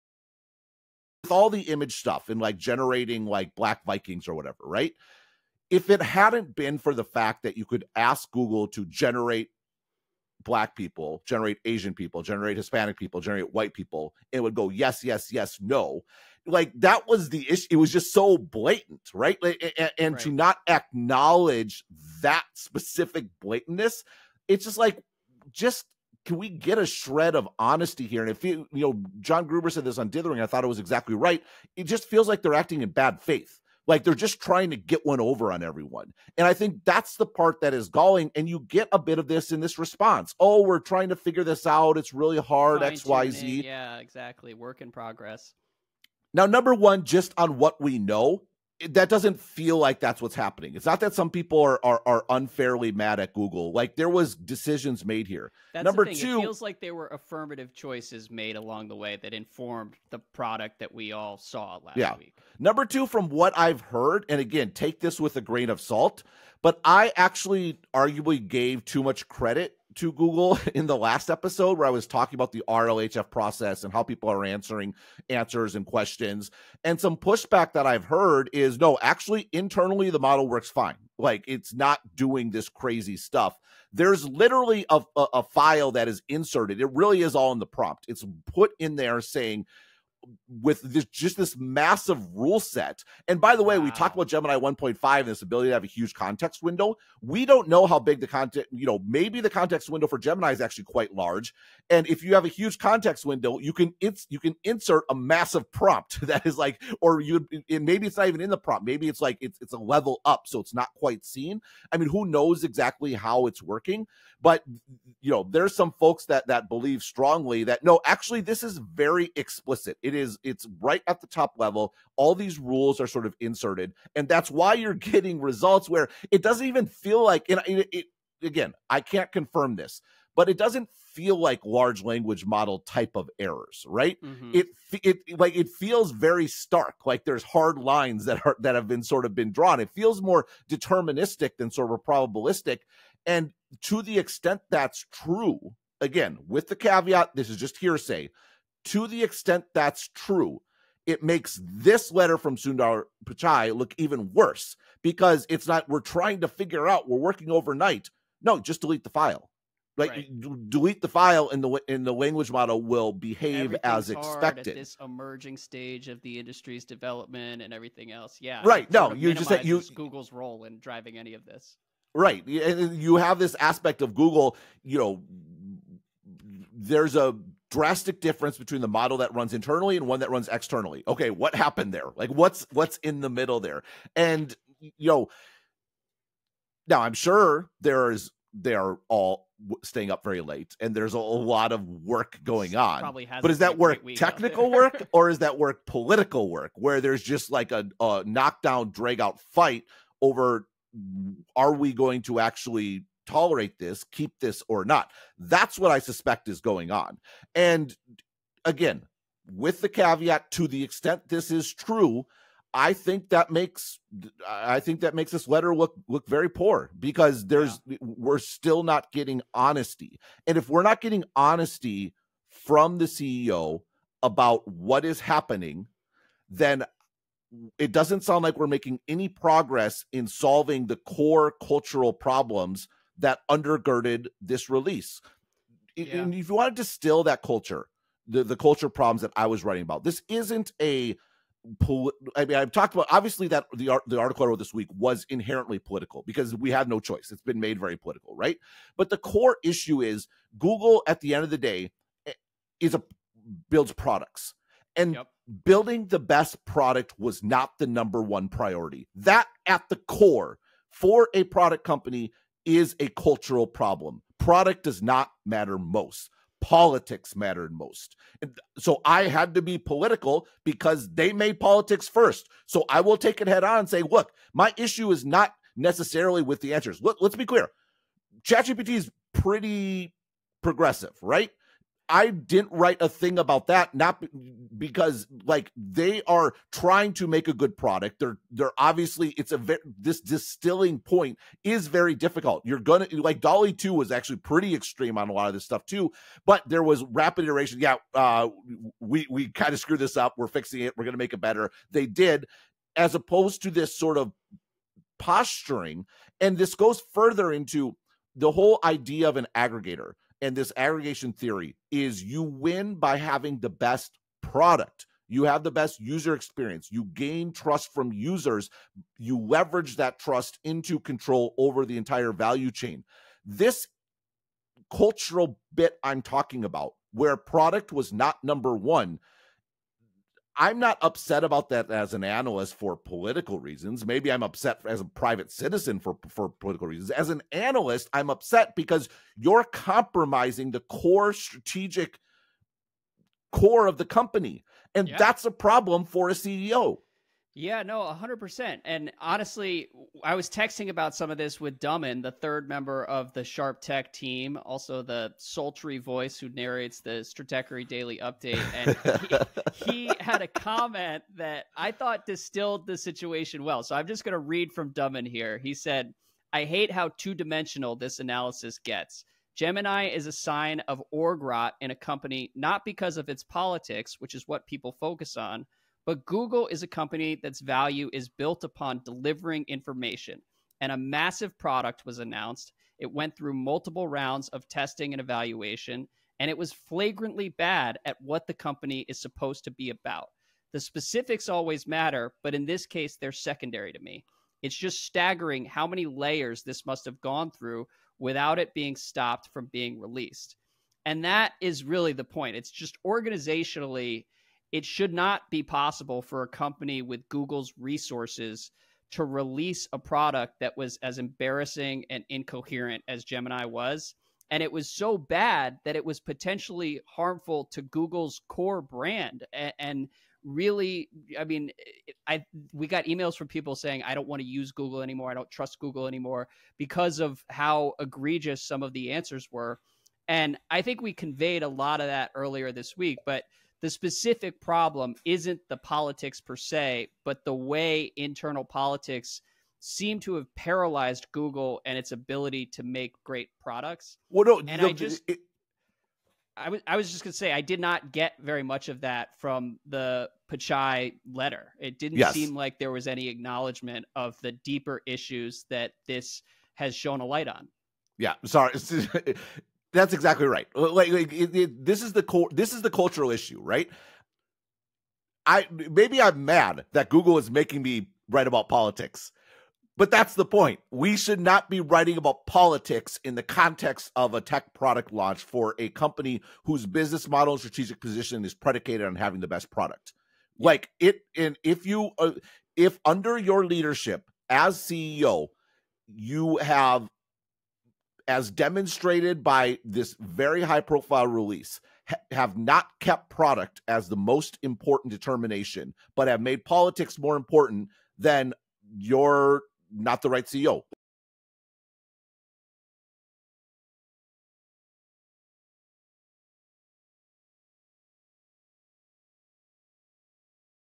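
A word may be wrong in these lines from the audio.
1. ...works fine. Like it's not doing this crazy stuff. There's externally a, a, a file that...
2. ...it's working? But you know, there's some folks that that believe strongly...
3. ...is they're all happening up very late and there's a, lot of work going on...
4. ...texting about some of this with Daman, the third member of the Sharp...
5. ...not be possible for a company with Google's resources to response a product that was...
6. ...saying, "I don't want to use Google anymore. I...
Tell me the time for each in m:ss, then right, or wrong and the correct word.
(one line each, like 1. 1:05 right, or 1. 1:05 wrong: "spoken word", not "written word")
1. 1:20 wrong: "literally", not "externally"
2. 1:53 right
3. 3:08 wrong: "staying", not "happening"
4. 5:50 right
5. 6:45 wrong: "release", not "response"
6. 7:03 right.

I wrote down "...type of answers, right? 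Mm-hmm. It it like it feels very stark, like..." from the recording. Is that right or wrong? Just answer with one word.
wrong.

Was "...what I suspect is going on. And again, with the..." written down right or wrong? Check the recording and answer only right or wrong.
right.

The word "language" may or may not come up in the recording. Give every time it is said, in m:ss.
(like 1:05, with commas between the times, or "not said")
2:12, 2:42.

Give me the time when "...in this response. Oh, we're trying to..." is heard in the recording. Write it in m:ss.
0:39.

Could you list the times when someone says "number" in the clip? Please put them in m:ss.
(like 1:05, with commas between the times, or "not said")
0:46, 0:55, 1:02, 4:17, 5:28.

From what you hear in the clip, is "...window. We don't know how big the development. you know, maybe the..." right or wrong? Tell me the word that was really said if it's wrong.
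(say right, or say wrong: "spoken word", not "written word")
wrong: "content", not "development".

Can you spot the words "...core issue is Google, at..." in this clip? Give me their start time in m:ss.
4:09.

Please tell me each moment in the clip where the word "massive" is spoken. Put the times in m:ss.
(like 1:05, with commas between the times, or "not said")
1:31, 1:45, 6:20.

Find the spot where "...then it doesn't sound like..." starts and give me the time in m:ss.
3:46.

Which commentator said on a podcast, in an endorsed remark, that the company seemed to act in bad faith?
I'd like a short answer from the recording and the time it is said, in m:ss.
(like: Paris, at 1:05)
John Gruber, at 0:29.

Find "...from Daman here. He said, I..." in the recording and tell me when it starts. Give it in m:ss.
6:04.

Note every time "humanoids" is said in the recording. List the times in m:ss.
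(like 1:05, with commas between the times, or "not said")
not said.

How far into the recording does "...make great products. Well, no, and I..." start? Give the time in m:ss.
7:22.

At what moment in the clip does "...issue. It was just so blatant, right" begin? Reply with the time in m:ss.
0:17.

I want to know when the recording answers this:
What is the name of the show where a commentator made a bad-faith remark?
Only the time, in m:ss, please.
0:30.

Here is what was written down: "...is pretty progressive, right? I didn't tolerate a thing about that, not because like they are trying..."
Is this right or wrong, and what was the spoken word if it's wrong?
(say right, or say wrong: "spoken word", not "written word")
wrong: "write", not "tolerate".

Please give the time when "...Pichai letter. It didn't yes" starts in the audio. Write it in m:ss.
7:30.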